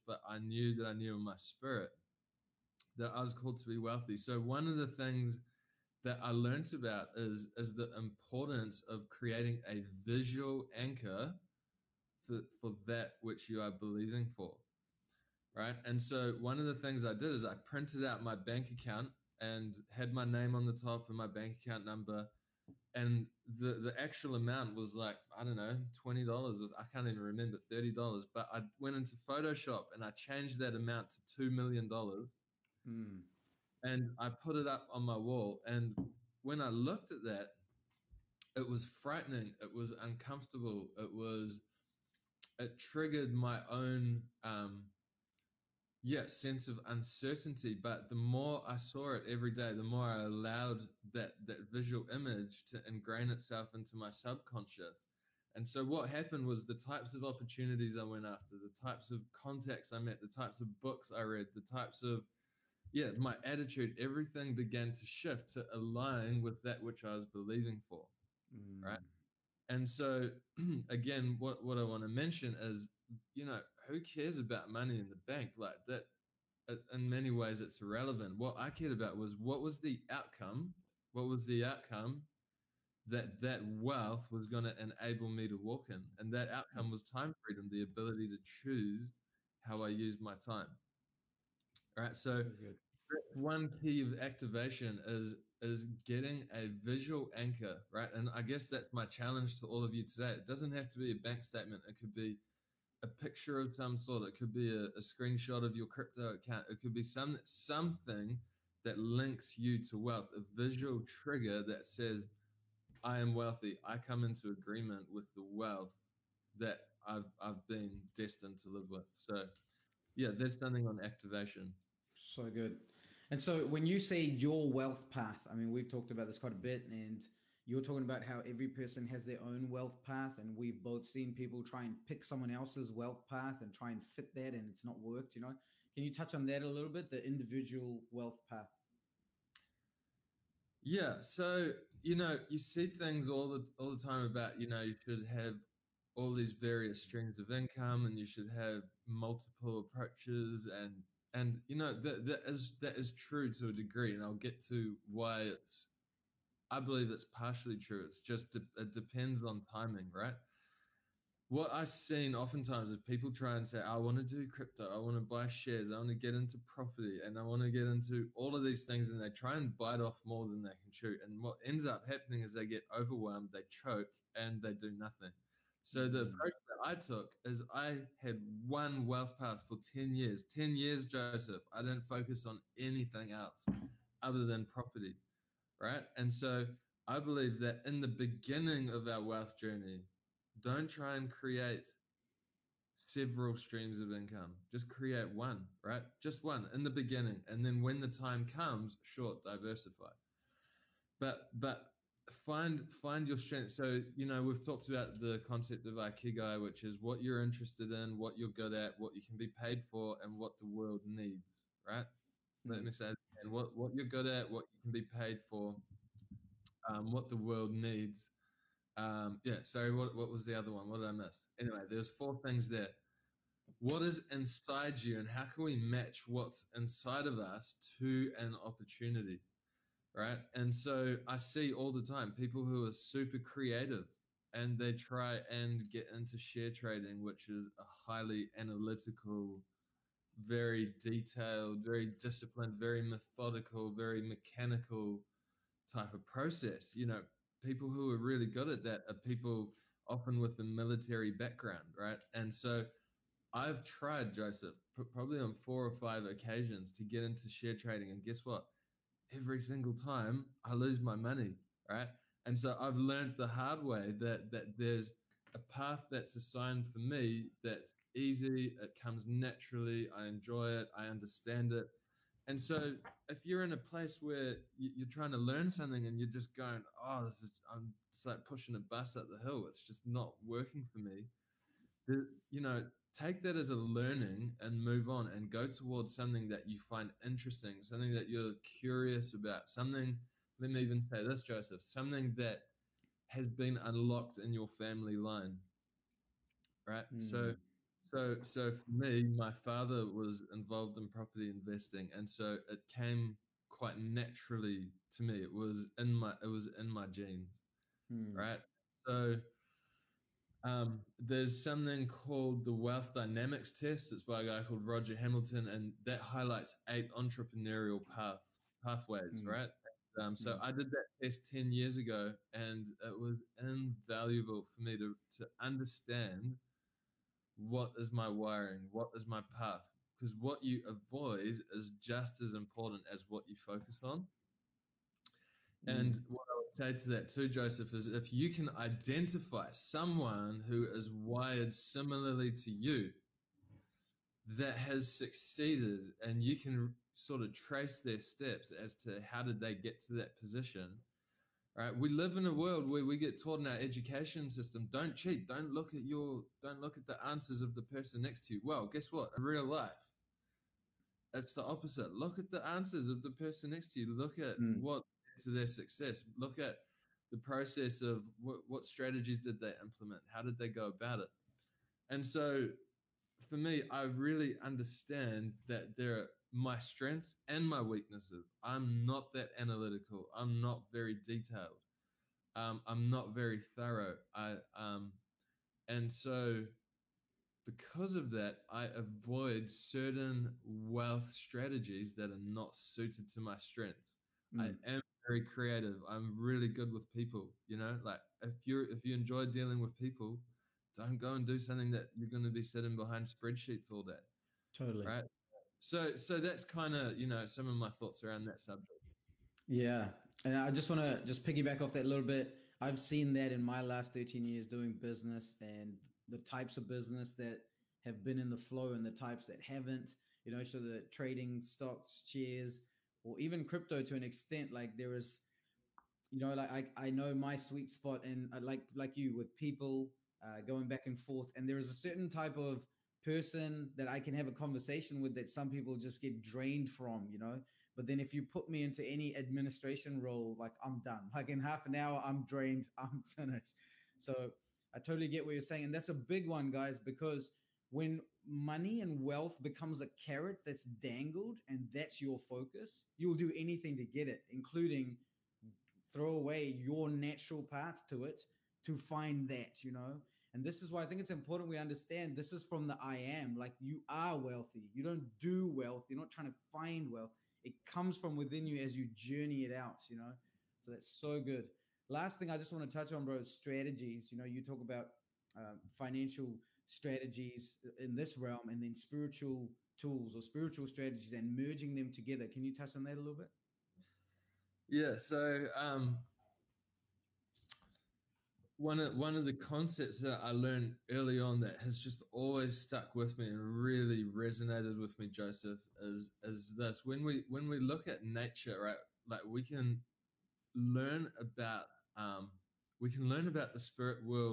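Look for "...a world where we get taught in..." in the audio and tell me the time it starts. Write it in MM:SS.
05:52.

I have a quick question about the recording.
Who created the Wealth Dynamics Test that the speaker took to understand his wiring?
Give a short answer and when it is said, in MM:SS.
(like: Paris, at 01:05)
Roger Hamilton, at 05:14.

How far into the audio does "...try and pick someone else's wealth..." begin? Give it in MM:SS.
02:11.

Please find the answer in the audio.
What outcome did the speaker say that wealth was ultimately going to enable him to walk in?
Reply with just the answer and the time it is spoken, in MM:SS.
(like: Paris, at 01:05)
time freedom, at 01:27.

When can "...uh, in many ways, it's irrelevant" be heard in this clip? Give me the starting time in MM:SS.
01:16.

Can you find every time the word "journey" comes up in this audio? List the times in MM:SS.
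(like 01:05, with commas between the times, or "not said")
03:09, 07:49.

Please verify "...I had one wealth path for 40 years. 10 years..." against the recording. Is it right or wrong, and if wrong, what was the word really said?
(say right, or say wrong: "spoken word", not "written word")
wrong: "10", not "40".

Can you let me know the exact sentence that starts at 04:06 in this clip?
You know, people who are really good at that are people often with a military background, right?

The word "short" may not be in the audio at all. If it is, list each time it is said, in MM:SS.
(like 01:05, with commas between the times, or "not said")
03:19.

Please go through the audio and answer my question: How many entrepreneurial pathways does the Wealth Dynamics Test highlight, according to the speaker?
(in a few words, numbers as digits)
8.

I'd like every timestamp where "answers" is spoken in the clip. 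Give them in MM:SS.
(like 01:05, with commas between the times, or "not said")
05:57, 06:02.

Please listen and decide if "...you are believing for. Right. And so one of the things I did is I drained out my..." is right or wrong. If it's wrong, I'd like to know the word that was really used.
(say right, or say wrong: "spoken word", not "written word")
wrong: "printed", not "drained".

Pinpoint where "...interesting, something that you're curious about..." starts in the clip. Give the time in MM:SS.
04:47.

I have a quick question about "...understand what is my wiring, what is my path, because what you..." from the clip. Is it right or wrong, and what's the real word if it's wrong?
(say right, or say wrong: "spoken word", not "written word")
right.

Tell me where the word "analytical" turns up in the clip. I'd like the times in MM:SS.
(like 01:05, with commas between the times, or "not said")
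03:58, 06:19.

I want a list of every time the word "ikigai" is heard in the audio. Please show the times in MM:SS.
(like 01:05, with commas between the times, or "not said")
03:25.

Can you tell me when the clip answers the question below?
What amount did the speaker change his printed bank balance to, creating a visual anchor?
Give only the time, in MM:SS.
00:31.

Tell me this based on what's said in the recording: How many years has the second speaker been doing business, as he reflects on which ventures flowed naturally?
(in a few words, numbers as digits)
13 years.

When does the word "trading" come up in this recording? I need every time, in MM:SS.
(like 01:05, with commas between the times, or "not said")
03:56, 04:17, 07:01.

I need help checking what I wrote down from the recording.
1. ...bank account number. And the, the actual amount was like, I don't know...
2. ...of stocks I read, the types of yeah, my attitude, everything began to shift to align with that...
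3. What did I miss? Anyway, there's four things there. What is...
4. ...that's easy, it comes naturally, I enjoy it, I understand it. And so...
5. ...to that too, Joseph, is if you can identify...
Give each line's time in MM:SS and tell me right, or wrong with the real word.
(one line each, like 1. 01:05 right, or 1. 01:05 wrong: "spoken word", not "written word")
1. 00:21 right
2. 01:00 wrong: "books", not "stocks"
3. 03:40 right
4. 04:27 right
5. 05:36 right.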